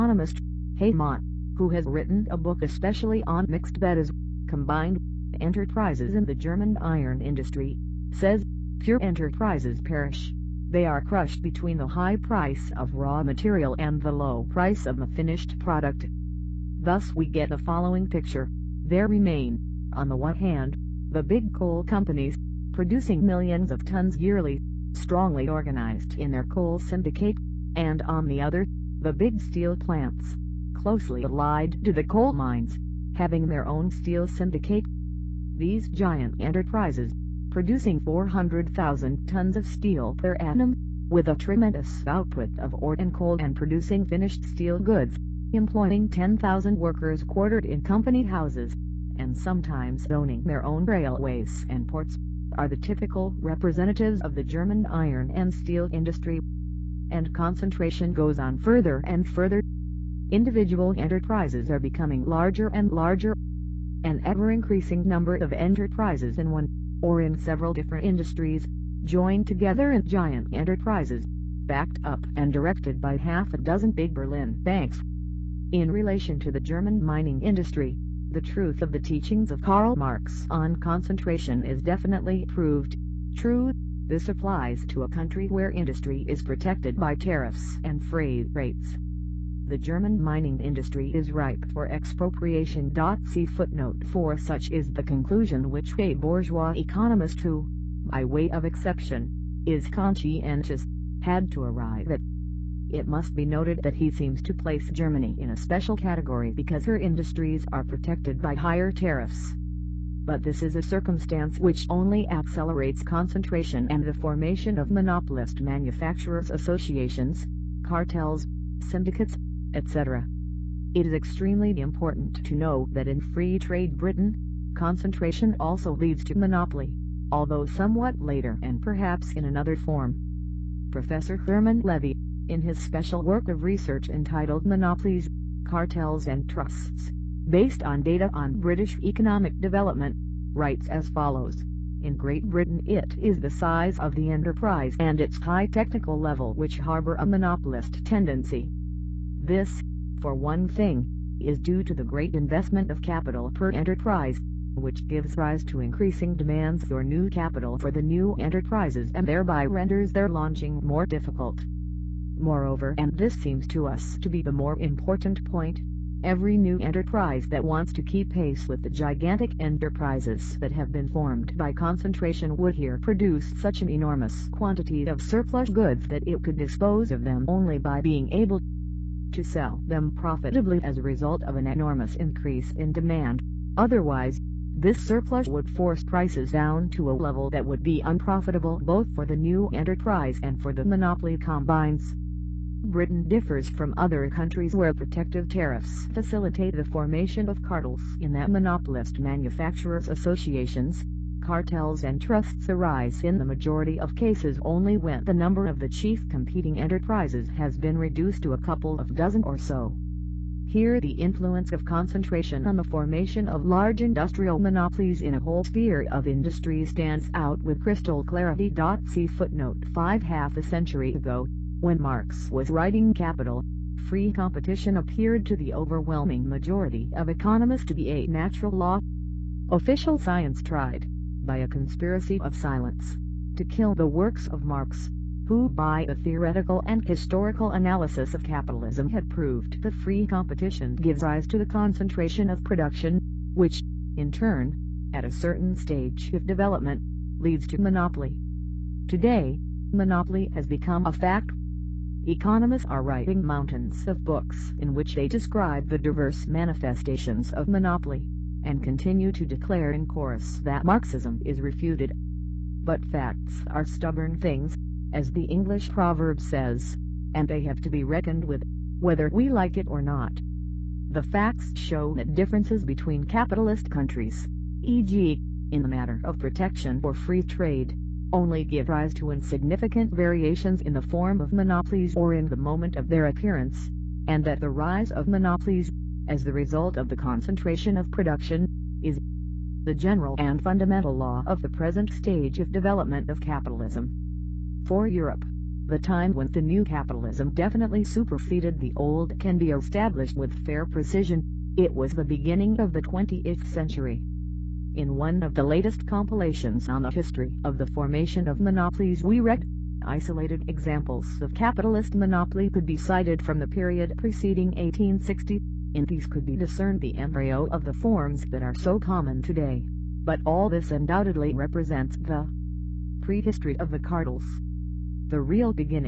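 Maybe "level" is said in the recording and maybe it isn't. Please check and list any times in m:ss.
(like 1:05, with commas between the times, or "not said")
2:26, 3:07.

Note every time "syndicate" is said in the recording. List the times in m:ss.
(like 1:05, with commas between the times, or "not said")
0:26, 0:34, 1:58.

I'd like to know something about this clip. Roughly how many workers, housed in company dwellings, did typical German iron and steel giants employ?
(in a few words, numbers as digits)
10,000.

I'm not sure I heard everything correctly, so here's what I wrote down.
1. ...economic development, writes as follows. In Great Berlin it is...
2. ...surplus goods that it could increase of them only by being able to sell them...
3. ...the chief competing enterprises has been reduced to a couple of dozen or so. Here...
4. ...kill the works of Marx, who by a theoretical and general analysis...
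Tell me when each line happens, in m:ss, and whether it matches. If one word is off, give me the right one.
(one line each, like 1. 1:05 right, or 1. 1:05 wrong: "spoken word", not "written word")
1. 2:19 wrong: "Britain", not "Berlin"
2. 2:55 wrong: "dispose", not "increase"
3. 3:25 right
4. 3:53 wrong: "historical", not "general".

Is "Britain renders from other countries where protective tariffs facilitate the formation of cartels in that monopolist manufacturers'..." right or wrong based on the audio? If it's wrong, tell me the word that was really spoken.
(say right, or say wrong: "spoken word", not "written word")
wrong: "differs", not "renders".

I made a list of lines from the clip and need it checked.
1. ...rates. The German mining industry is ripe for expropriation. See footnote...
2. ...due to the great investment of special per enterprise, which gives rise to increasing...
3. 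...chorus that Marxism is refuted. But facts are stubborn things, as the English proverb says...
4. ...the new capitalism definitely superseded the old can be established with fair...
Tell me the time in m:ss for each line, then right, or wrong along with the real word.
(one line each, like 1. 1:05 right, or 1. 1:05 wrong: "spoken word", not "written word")
1. 1:28 right
2. 2:31 wrong: "capital", not "special"
3. 4:20 right
4. 4:56 right.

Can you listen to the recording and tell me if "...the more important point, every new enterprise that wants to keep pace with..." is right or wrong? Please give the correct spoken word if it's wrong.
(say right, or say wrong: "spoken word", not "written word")
right.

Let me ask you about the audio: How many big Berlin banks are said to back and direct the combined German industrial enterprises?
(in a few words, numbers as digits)
half a dozen.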